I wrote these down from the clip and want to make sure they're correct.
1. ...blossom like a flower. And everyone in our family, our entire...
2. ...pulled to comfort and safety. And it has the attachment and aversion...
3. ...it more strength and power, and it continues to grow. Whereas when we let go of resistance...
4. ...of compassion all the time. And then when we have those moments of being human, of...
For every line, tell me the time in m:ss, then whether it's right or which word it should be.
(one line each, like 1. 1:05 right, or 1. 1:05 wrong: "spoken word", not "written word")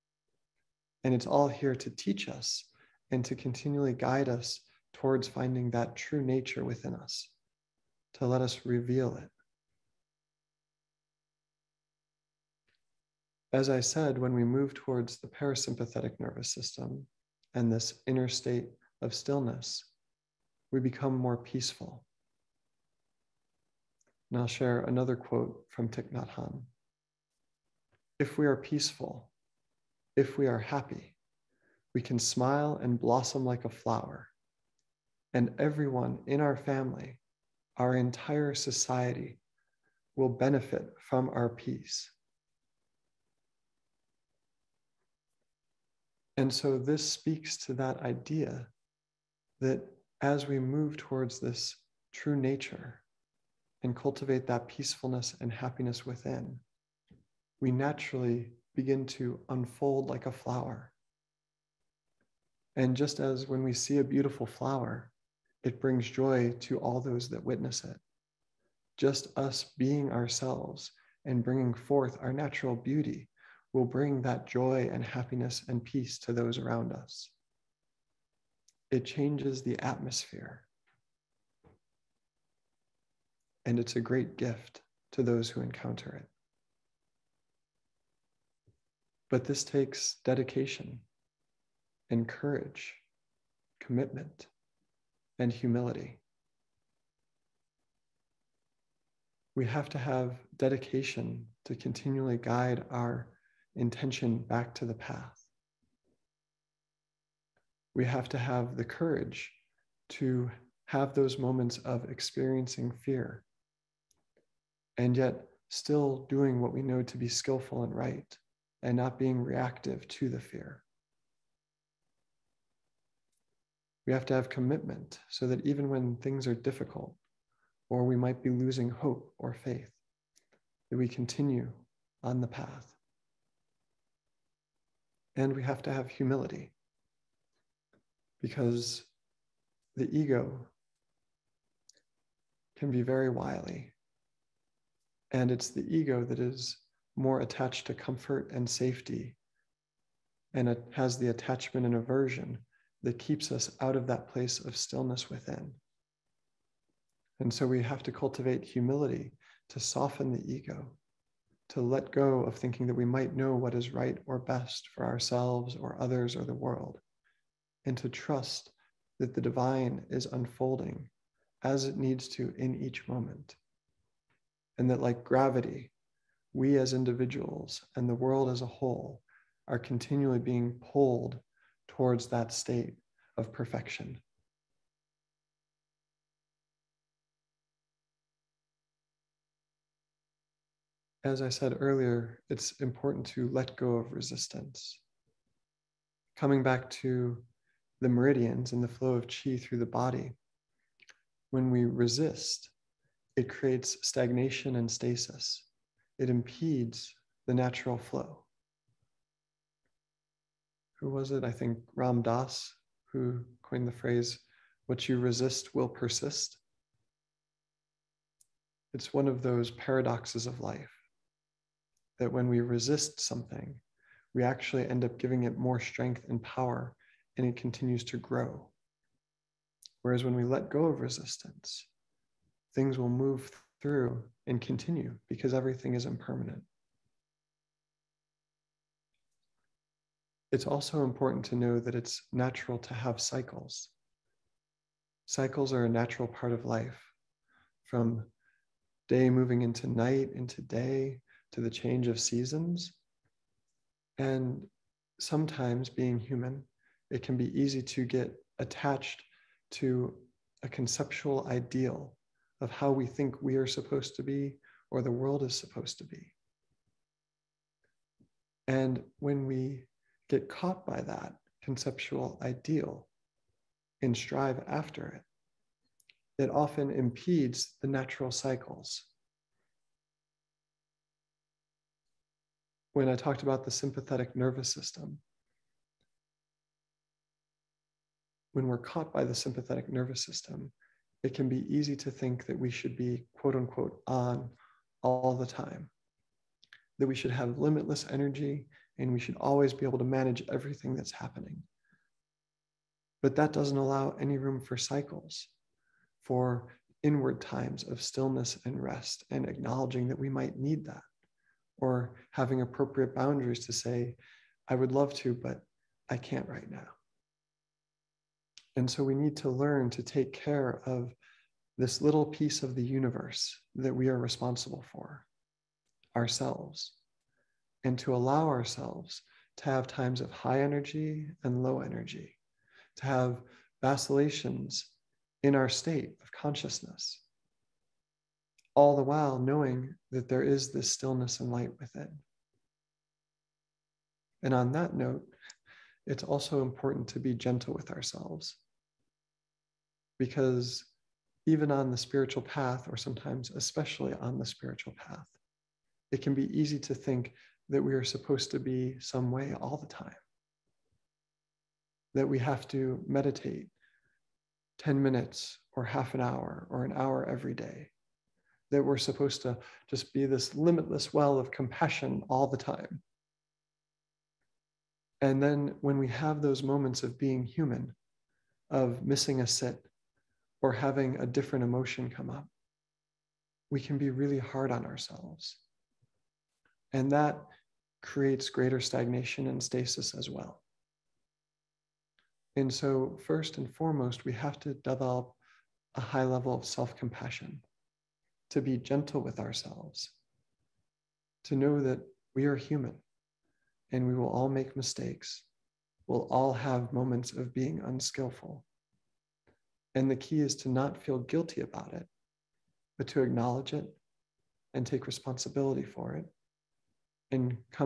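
1. 0:32 right
2. 2:27 wrong: "attached", not "pulled"
3. 3:45 right
4. 6:11 right.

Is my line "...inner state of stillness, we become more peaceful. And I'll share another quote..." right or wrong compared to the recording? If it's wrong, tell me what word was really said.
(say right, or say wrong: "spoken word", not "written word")
right.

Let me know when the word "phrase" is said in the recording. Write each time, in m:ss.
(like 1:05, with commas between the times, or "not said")
3:33.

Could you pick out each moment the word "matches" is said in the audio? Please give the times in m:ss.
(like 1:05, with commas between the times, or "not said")
not said.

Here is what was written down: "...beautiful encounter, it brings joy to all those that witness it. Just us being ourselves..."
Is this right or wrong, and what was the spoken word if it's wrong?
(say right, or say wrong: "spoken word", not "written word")
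wrong: "flower", not "encounter".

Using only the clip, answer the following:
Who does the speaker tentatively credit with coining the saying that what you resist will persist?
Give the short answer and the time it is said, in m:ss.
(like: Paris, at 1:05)
Ram Dass, at 3:31.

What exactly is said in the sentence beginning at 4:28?
And when we get caught by that conceptual ideal and strive after it, it often impedes the natural cycles.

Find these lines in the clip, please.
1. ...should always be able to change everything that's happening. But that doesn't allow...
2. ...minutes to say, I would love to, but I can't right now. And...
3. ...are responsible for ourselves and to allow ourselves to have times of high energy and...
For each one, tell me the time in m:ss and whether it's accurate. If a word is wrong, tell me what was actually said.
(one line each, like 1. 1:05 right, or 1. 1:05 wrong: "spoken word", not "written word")
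1. 4:59 wrong: "manage", not "change"
2. 5:13 wrong: "boundaries", not "minutes"
3. 5:24 right.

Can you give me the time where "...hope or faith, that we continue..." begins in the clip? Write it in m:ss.
2:08.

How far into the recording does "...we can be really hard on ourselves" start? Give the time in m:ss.
6:23.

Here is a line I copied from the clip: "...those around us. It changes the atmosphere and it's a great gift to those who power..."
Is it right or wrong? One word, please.
wrong.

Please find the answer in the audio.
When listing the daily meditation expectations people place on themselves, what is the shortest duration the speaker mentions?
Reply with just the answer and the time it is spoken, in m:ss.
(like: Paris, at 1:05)
10 minutes, at 6:04.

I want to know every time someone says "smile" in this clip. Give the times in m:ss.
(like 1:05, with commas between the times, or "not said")
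0:32.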